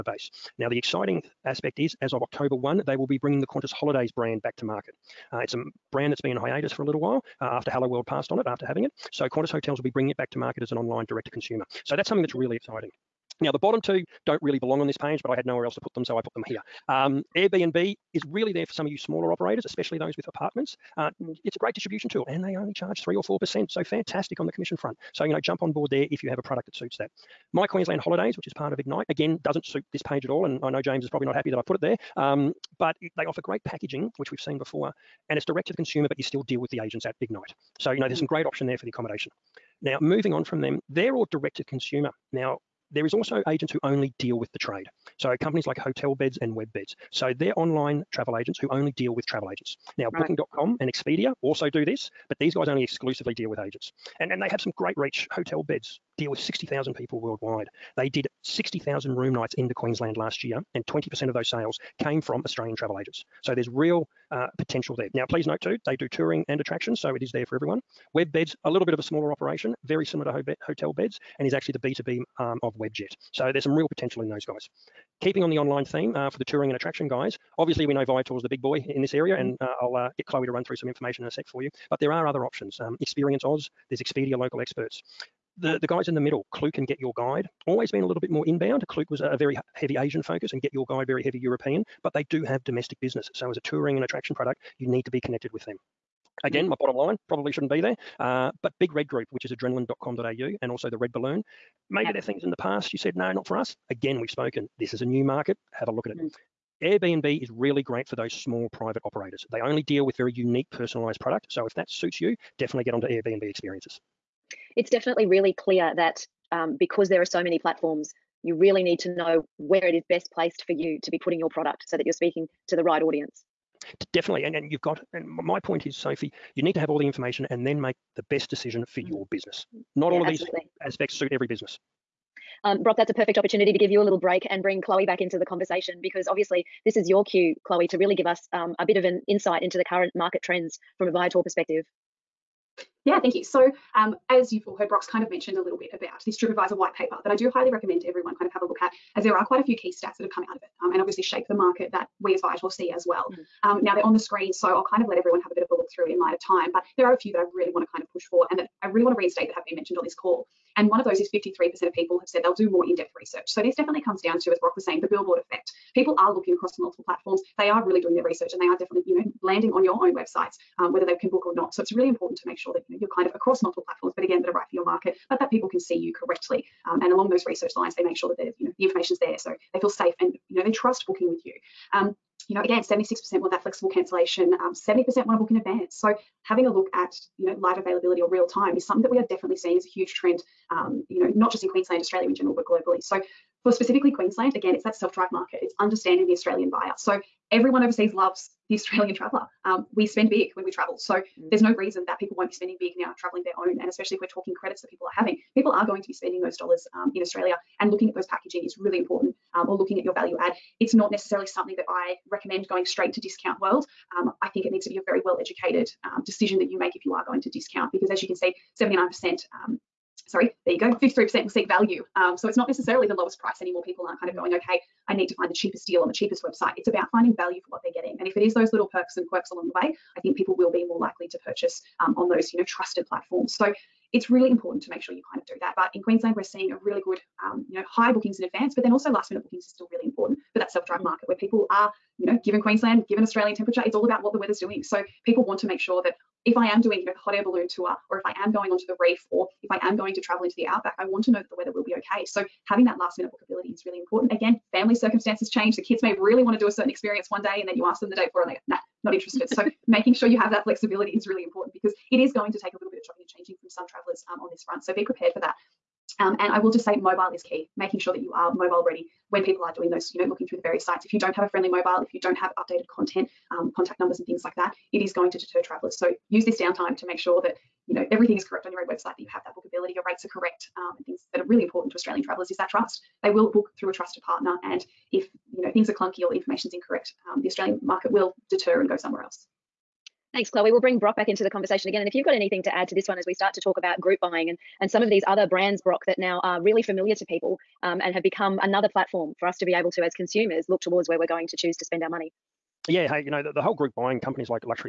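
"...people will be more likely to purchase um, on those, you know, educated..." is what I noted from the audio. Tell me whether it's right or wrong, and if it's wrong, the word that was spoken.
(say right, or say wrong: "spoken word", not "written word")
wrong: "trusted", not "educated".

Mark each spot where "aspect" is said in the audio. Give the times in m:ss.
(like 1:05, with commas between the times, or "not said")
0:01, 2:10.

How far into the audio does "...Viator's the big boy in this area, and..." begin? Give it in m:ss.
1:18.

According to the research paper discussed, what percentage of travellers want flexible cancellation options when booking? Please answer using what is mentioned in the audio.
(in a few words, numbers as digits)
76%.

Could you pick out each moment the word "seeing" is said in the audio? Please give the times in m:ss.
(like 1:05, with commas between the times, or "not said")
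3:09, 3:56.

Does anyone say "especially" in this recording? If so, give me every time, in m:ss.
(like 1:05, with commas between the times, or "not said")
0:19, 3:23.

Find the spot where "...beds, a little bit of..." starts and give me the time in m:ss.
1:08.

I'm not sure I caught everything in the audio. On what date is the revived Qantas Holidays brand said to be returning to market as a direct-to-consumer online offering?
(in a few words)
October 1.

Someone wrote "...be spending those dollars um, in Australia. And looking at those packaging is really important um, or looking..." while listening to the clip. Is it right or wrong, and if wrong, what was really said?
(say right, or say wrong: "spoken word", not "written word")
right.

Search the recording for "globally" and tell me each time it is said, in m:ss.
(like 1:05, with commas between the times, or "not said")
3:12.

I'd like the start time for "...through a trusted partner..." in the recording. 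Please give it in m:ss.
4:43.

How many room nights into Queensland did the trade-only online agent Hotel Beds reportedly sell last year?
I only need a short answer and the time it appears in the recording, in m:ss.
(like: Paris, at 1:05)
60,000, at 0:58.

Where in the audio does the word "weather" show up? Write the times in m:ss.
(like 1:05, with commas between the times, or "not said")
4:04, 4:11.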